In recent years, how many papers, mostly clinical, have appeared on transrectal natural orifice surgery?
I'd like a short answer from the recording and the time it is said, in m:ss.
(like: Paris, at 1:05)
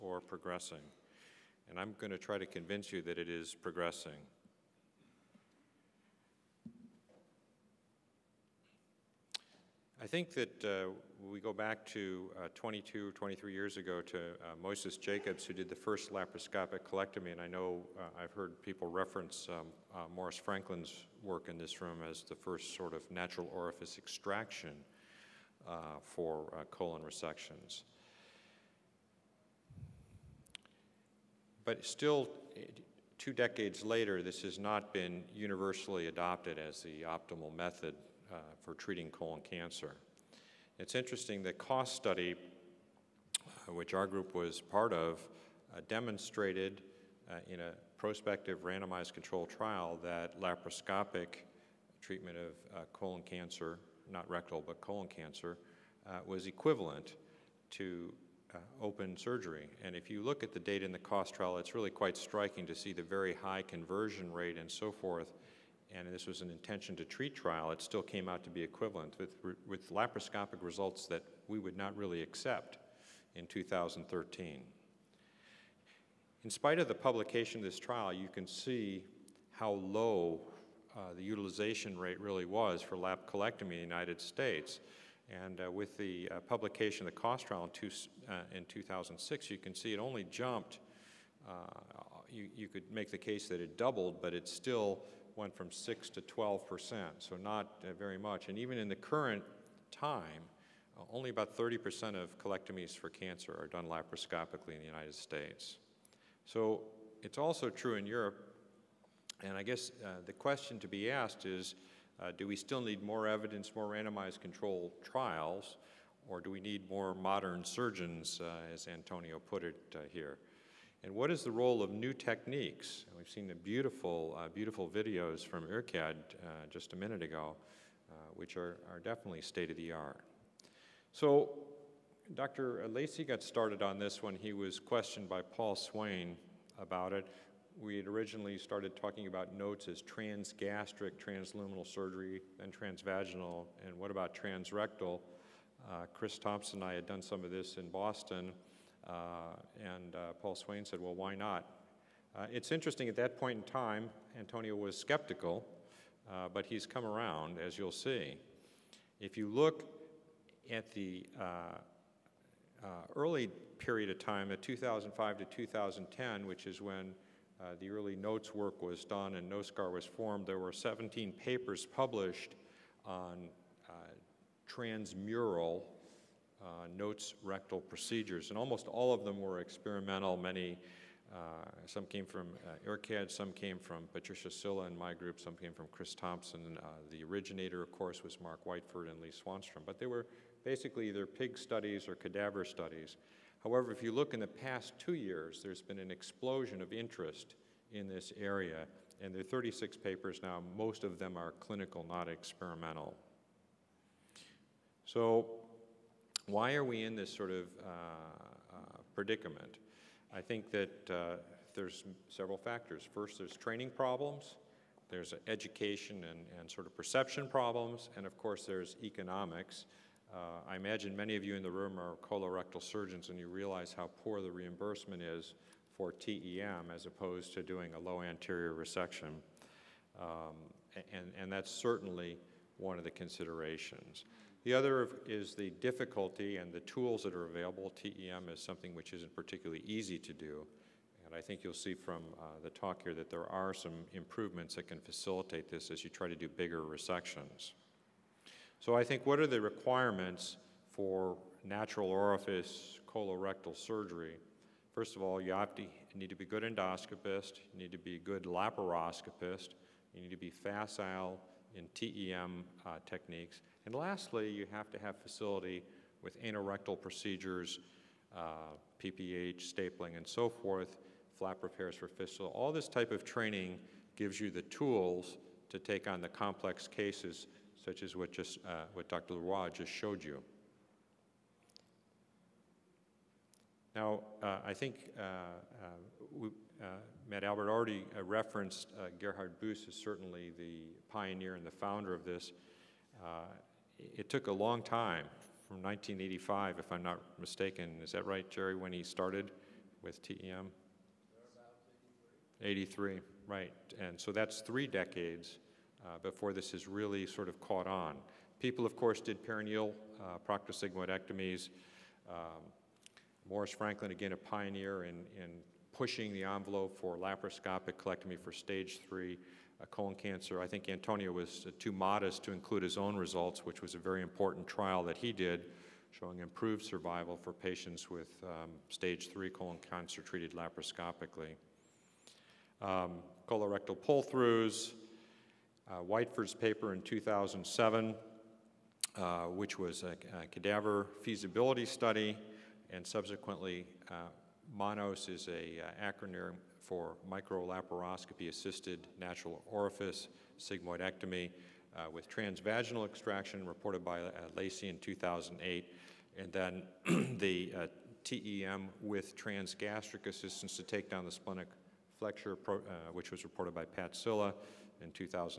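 36, at 3:19.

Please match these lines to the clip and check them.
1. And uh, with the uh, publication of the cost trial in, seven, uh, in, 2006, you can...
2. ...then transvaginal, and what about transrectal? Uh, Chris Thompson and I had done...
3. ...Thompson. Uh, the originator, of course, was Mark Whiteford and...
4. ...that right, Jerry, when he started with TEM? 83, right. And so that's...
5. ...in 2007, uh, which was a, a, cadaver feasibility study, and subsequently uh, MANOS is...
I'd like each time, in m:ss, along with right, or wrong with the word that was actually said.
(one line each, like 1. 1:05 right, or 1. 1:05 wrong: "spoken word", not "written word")
1. 1:25 wrong: "two", not "seven"
2. 2:22 right
3. 3:06 right
4. 4:58 right
5. 5:36 right.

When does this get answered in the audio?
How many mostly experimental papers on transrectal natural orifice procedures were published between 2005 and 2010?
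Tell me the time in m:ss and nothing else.
2:50.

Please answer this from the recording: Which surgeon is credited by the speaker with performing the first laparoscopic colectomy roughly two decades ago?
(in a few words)
Moises Jacobs.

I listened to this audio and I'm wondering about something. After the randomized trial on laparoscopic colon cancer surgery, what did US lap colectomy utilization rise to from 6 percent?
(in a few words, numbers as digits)
12 percent.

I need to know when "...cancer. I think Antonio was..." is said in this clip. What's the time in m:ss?
5:20.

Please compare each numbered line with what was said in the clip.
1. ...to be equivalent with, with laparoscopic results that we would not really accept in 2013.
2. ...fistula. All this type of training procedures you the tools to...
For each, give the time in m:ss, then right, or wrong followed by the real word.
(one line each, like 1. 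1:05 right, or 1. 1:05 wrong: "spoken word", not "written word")
1. 1:08 right
2. 4:32 wrong: "gives", not "procedures".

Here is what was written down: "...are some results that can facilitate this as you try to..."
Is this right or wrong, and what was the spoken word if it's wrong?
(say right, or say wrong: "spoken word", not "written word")
wrong: "improvements", not "results".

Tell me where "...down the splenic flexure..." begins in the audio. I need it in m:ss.
6:01.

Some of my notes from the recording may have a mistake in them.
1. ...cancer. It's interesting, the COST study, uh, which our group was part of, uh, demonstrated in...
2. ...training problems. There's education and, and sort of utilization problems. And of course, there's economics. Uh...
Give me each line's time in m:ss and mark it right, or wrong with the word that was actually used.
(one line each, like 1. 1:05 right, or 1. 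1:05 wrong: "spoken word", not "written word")
1. 0:39 right
2. 3:33 wrong: "perception", not "utilization".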